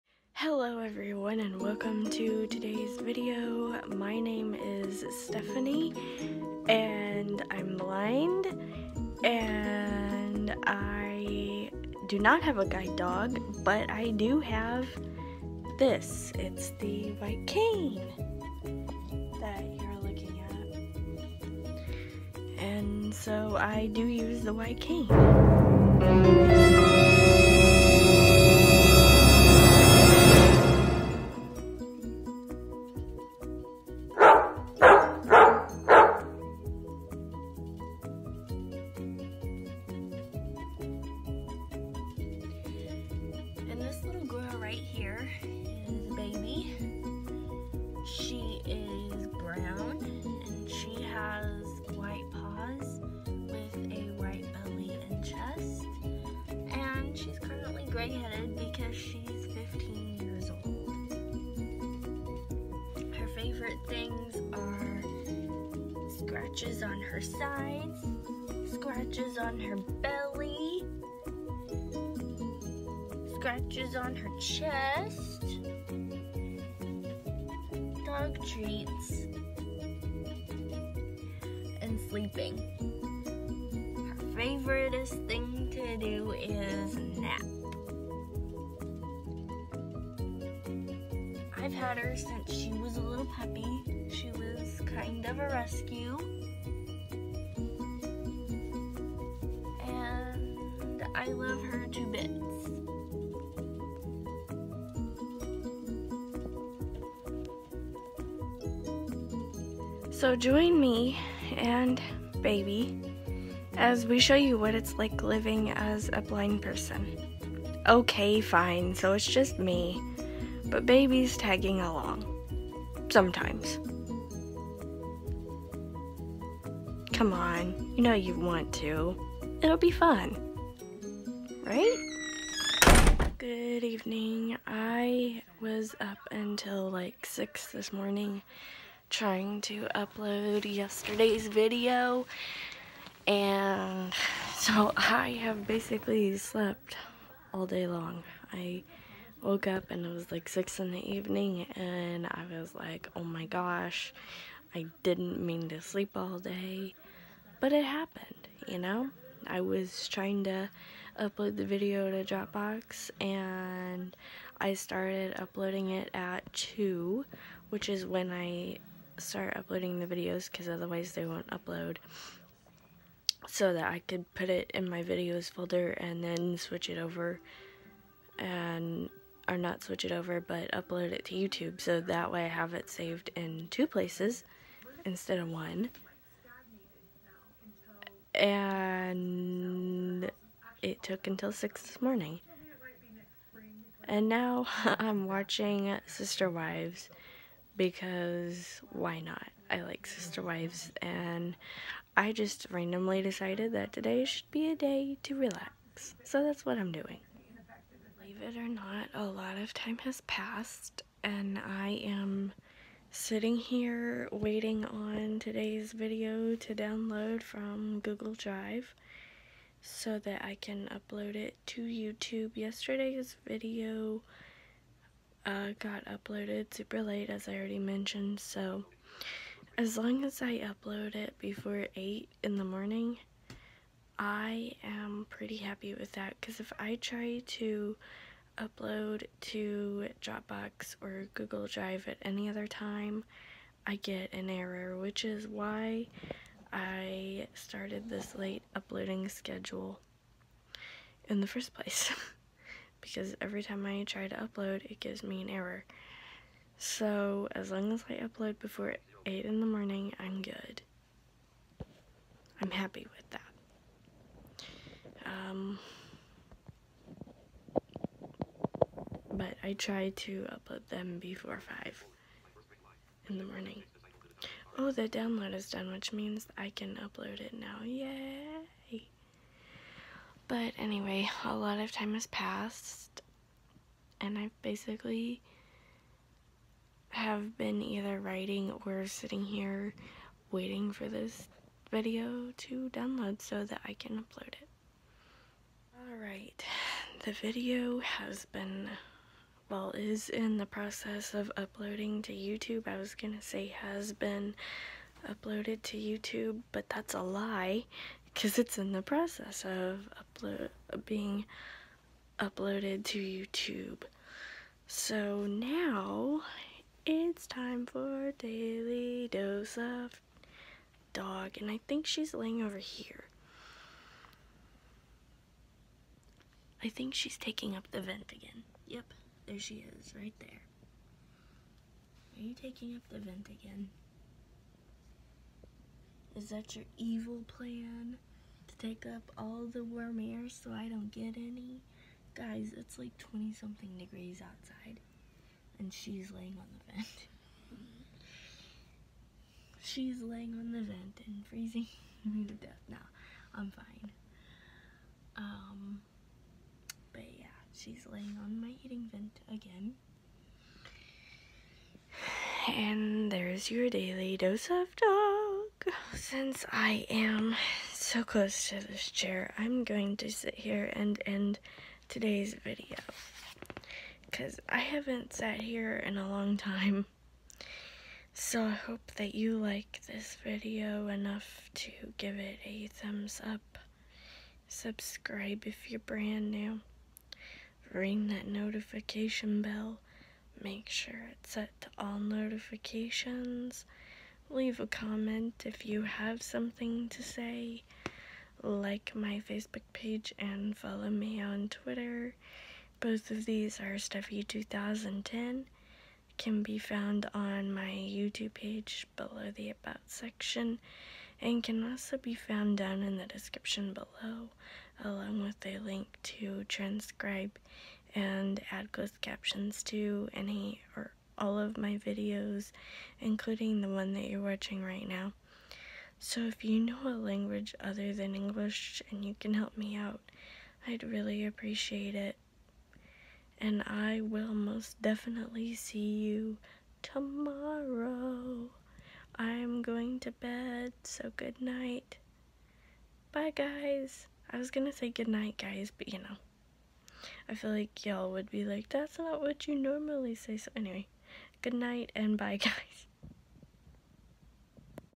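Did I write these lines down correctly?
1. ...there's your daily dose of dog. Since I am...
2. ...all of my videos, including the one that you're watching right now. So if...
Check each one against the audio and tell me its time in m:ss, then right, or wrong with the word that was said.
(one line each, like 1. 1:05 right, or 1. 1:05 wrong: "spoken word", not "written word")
1. 6:03 right
2. 7:01 right.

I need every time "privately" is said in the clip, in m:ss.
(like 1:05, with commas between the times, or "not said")
not said.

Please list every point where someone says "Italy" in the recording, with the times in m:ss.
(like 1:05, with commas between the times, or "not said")
not said.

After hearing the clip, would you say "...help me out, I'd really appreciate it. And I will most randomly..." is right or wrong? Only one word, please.
wrong.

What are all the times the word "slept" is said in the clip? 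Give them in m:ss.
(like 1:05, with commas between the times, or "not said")
2:26.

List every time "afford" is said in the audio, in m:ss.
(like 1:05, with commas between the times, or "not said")
not said.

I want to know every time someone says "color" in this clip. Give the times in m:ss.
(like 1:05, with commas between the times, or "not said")
not said.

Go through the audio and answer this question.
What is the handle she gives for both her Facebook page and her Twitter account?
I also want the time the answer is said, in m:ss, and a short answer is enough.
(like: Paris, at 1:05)
Stephie2010, at 6:43.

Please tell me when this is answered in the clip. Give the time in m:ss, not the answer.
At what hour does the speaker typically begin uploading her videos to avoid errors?
2:46.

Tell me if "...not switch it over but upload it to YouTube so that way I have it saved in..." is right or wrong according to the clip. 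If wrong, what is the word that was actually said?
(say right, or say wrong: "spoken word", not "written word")
right.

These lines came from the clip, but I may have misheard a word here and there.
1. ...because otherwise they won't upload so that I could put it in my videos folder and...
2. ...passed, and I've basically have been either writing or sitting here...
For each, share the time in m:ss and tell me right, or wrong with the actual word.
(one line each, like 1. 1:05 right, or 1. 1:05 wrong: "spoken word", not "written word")
1. 2:50 right
2. 4:42 right.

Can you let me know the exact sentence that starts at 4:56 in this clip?
Alright, the video has been, well, is in the process of uploading to YouTube.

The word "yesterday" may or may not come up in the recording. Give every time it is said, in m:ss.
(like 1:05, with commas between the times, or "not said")
2:20, 3:42.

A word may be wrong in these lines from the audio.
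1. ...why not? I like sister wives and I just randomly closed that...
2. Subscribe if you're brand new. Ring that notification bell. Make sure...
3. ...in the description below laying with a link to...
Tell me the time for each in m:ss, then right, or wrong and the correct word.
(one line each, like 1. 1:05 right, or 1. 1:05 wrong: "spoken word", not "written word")
1. 3:18 wrong: "decided", not "closed"
2. 6:24 right
3. 6:53 wrong: "along", not "laying".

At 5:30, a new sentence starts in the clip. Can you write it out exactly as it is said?
Are you taking up the vent again?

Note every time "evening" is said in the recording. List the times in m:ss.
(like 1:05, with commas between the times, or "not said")
2:13, 2:31.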